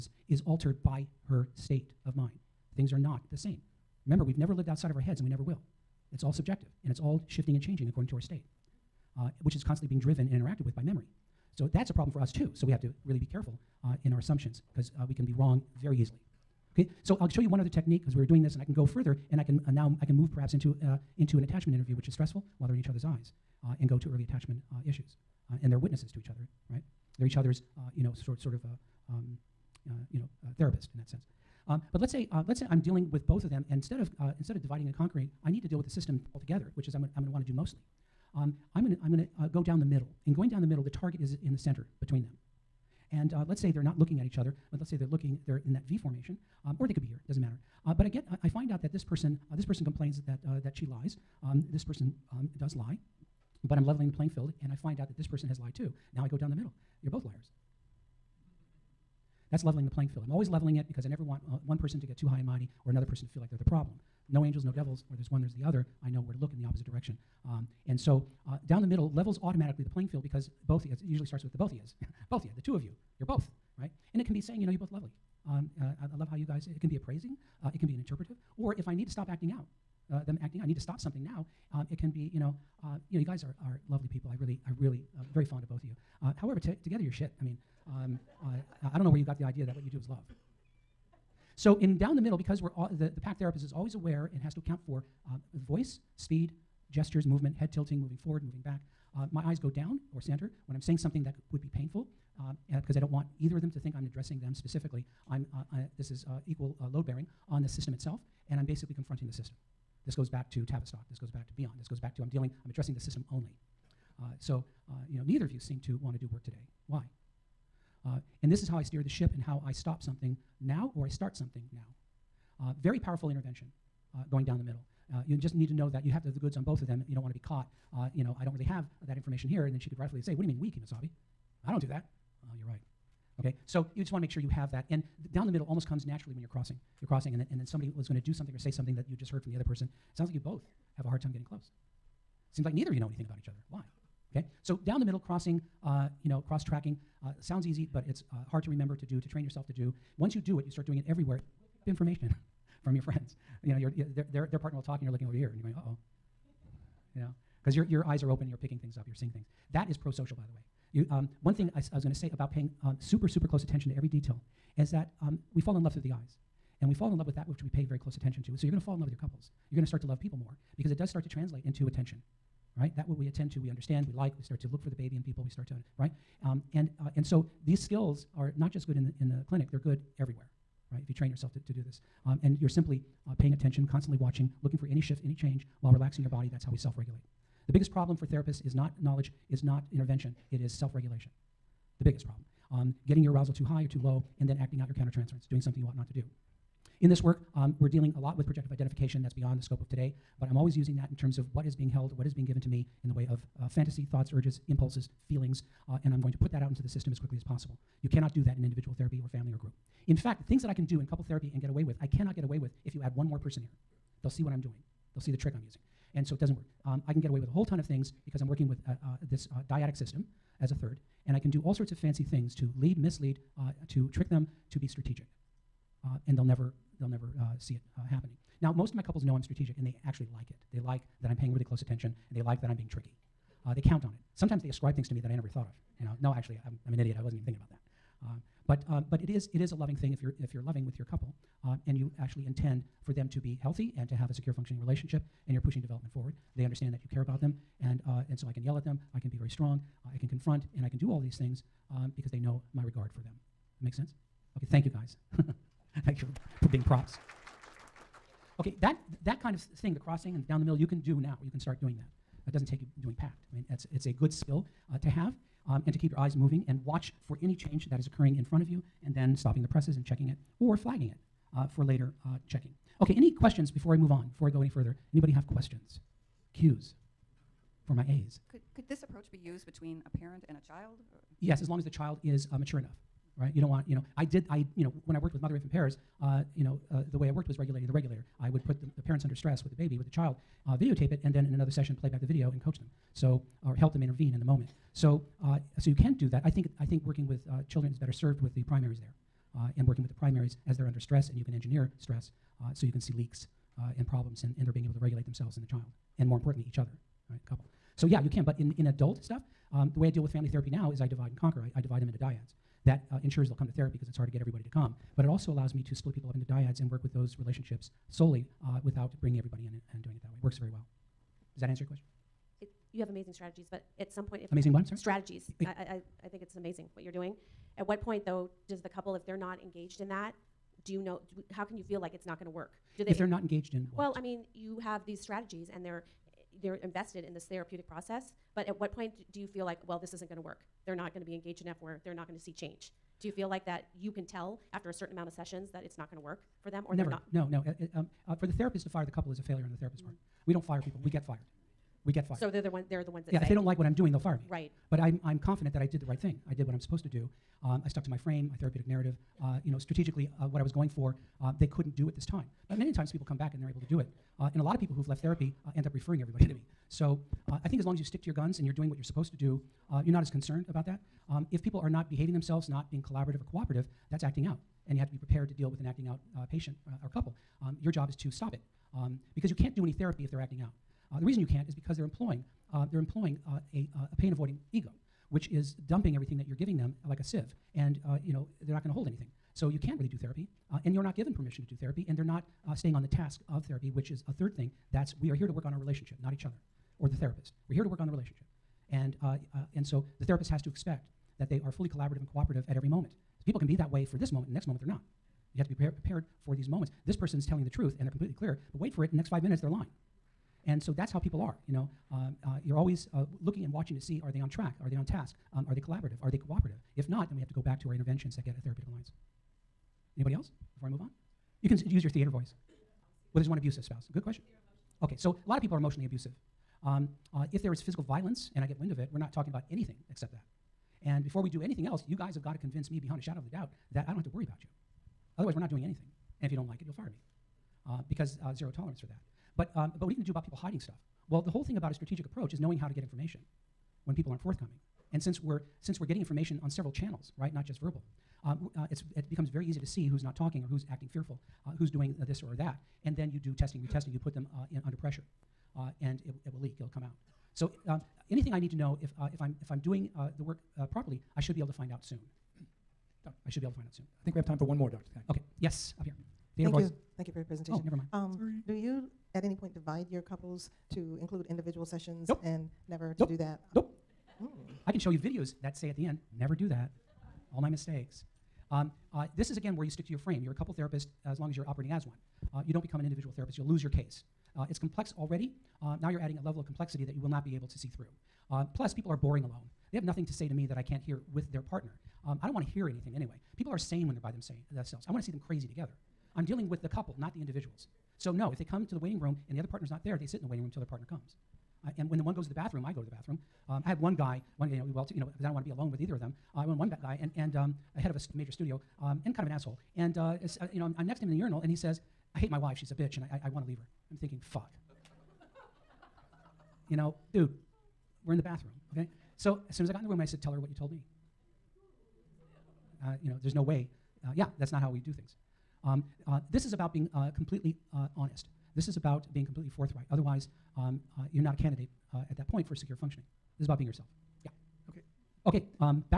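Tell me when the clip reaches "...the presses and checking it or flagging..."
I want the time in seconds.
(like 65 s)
269 s.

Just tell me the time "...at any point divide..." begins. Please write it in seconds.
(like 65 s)
469 s.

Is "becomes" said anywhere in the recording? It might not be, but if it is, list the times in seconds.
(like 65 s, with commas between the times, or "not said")
449 s, 482 s.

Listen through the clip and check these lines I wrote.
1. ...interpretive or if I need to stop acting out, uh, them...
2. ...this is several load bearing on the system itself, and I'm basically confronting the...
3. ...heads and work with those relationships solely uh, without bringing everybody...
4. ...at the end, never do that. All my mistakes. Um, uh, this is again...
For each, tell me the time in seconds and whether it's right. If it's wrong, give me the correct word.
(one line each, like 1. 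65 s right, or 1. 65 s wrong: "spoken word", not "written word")
1. 77 s right
2. 105 s wrong: "equal", not "several"
3. 316 s wrong: "dyads", not "heads"
4. 475 s right.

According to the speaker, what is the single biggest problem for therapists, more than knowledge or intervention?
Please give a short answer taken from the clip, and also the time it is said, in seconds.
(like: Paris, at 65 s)
Self regulation, at 190 s.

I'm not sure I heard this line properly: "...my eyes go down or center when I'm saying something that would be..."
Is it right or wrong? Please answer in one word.
right.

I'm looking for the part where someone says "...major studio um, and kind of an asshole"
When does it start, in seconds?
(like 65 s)
508 s.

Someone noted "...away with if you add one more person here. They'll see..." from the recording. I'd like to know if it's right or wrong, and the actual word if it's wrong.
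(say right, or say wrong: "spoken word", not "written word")
right.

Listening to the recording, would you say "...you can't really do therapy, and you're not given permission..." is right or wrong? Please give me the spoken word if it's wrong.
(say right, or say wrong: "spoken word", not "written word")
right.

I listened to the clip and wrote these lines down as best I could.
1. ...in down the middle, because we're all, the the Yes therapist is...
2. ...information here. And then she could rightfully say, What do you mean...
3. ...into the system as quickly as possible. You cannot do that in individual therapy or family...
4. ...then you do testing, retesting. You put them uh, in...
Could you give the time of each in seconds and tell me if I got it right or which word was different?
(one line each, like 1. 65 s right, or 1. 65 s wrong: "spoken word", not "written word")
1. 91 s wrong: "PACT", not "Yes"
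2. 129 s right
3. 206 s right
4. 453 s right.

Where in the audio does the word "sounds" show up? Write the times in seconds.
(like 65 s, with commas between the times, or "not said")
140 s, 147 s.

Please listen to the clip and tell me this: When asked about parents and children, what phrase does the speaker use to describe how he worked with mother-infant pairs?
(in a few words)
Regulating the regulator.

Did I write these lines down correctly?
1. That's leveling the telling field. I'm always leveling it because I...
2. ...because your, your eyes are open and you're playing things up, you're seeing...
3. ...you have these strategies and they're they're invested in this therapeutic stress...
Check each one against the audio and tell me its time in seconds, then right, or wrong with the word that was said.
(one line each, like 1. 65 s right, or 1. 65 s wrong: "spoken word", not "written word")
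1. 59 s wrong: "playing", not "telling"
2. 157 s wrong: "picking", not "playing"
3. 334 s wrong: "process", not "stress".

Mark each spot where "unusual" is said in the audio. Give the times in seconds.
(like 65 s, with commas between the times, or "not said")
not said.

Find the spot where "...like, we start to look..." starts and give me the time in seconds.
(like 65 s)
174 s.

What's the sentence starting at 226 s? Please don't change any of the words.
Uh, and they'll never they'll never uh, see it uh, happening.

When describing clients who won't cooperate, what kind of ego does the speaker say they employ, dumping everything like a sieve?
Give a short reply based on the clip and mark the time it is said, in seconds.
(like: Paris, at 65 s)
Pain avoiding ego, at 384 s.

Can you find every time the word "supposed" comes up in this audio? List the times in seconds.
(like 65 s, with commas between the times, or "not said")
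356 s, 369 s.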